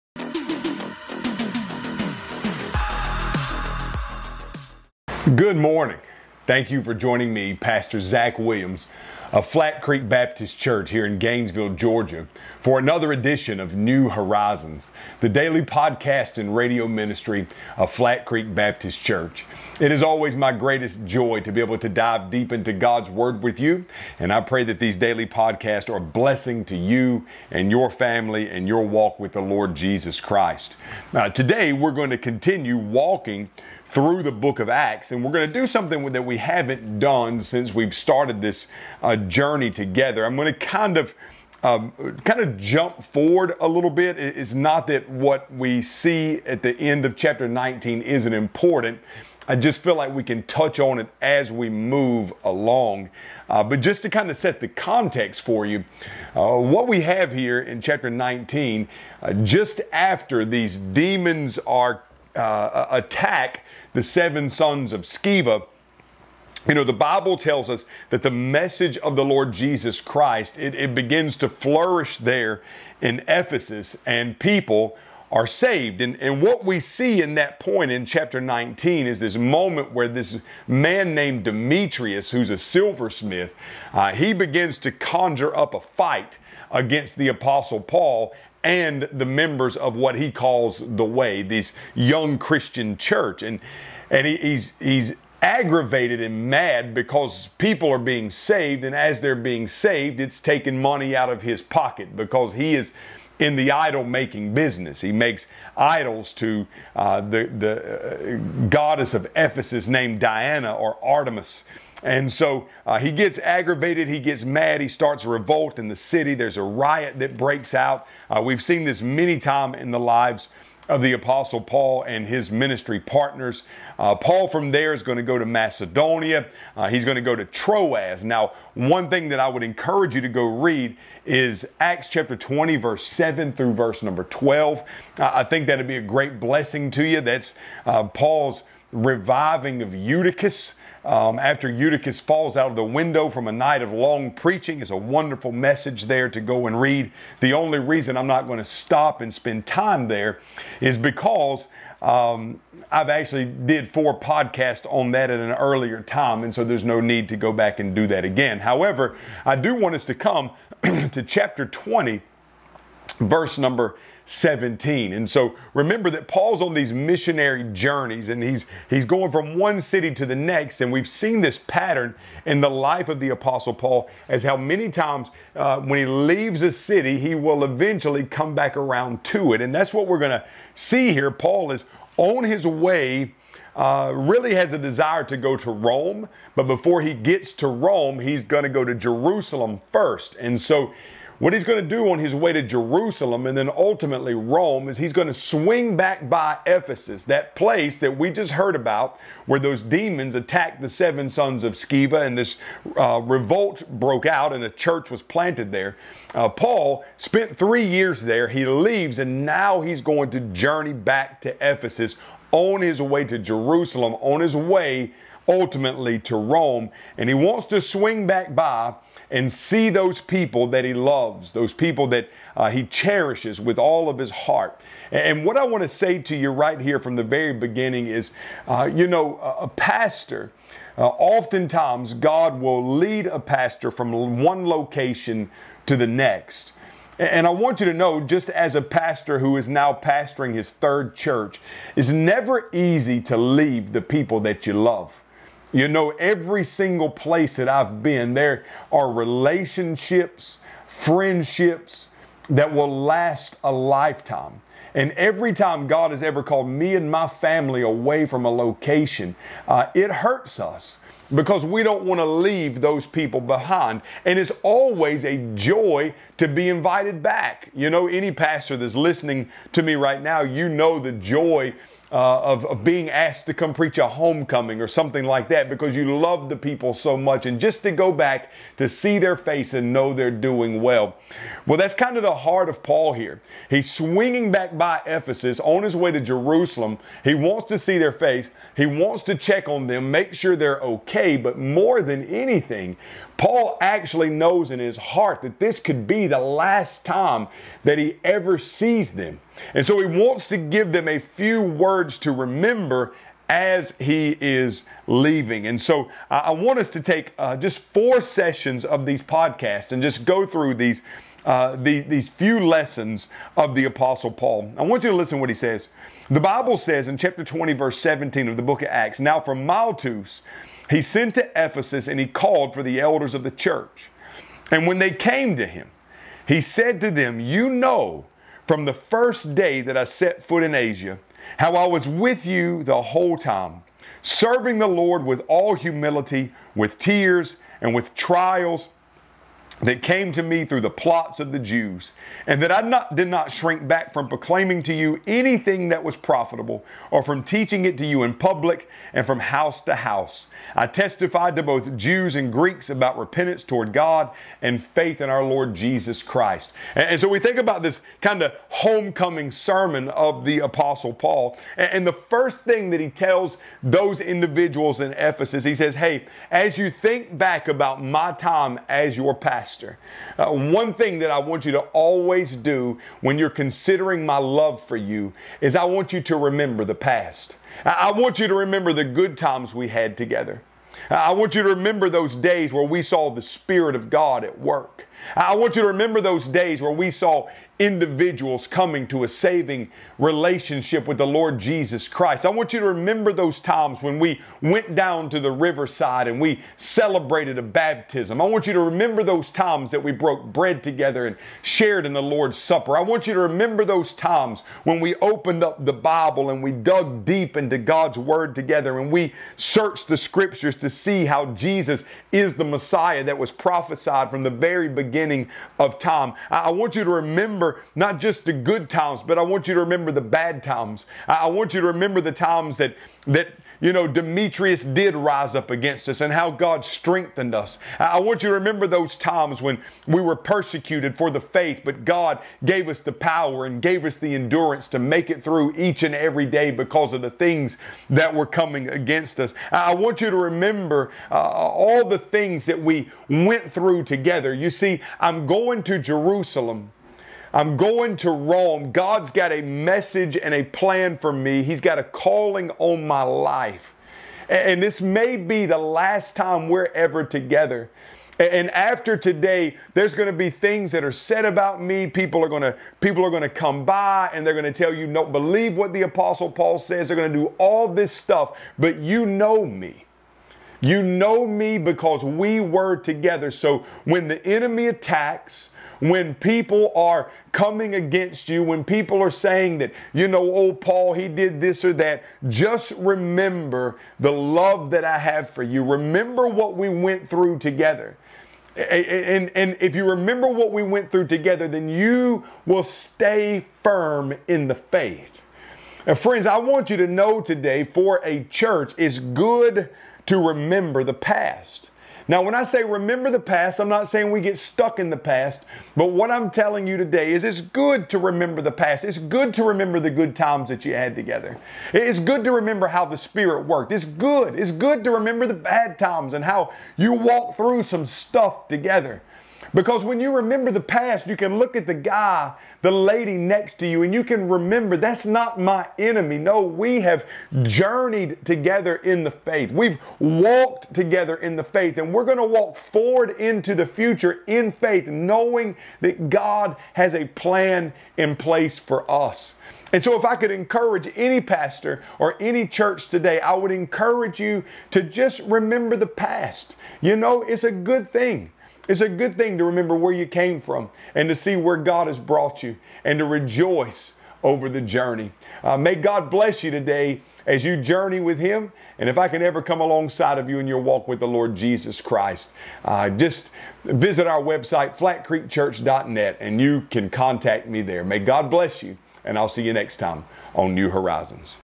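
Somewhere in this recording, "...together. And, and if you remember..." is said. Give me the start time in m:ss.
8:07.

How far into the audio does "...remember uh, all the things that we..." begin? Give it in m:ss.
7:20.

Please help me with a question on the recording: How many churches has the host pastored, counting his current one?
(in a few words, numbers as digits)
3.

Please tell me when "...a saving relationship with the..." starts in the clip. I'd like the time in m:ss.
6:29.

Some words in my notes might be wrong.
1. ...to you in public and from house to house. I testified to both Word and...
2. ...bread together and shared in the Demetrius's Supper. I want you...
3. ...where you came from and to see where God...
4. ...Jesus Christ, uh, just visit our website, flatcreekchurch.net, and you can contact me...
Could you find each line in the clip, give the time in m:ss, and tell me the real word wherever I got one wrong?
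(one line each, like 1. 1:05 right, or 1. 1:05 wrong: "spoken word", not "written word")
1. 5:47 wrong: "Jews", not "Word"
2. 6:40 wrong: "Lord", not "Demetrius"
3. 9:09 right
4. 9:21 right.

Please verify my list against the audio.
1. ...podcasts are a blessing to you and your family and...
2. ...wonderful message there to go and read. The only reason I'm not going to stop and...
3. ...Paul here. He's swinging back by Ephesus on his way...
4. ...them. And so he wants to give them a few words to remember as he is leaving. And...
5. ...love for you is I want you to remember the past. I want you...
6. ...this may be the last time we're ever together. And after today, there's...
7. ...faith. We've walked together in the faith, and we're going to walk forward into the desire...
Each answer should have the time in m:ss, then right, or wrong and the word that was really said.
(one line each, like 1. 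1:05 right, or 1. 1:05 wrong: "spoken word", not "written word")
1. 0:25 right
2. 2:24 right
3. 4:42 right
4. 4:59 right
5. 6:14 right
6. 7:34 right
7. 8:49 wrong: "future", not "desire".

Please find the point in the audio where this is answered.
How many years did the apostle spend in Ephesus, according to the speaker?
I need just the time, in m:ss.
3:27.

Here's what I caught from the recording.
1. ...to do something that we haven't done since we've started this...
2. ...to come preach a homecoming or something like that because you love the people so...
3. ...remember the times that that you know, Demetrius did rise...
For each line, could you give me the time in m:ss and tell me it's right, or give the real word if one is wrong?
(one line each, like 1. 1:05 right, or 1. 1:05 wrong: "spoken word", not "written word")
1. 0:35 right
2. 4:33 right
3. 7:01 right.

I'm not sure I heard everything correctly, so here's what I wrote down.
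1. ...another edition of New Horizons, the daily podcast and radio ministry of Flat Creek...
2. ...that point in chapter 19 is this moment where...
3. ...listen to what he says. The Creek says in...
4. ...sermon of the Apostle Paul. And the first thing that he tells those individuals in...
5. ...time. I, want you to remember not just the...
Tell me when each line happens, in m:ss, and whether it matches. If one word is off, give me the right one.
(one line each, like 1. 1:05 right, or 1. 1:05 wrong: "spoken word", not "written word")
1. 0:12 right
2. 1:17 right
3. 5:15 wrong: "Bible", not "Creek"
4. 5:59 right
5. 6:55 right.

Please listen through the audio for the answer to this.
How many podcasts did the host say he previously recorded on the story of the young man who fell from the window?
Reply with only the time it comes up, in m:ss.
2:33.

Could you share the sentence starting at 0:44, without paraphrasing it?
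It's not that what we see at the end of chapter 19 isn't important.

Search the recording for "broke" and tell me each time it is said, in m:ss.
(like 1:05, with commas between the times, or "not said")
3:23, 6:40.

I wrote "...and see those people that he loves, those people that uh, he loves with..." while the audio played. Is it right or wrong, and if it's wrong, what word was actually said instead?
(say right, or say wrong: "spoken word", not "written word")
wrong: "cherishes", not "loves".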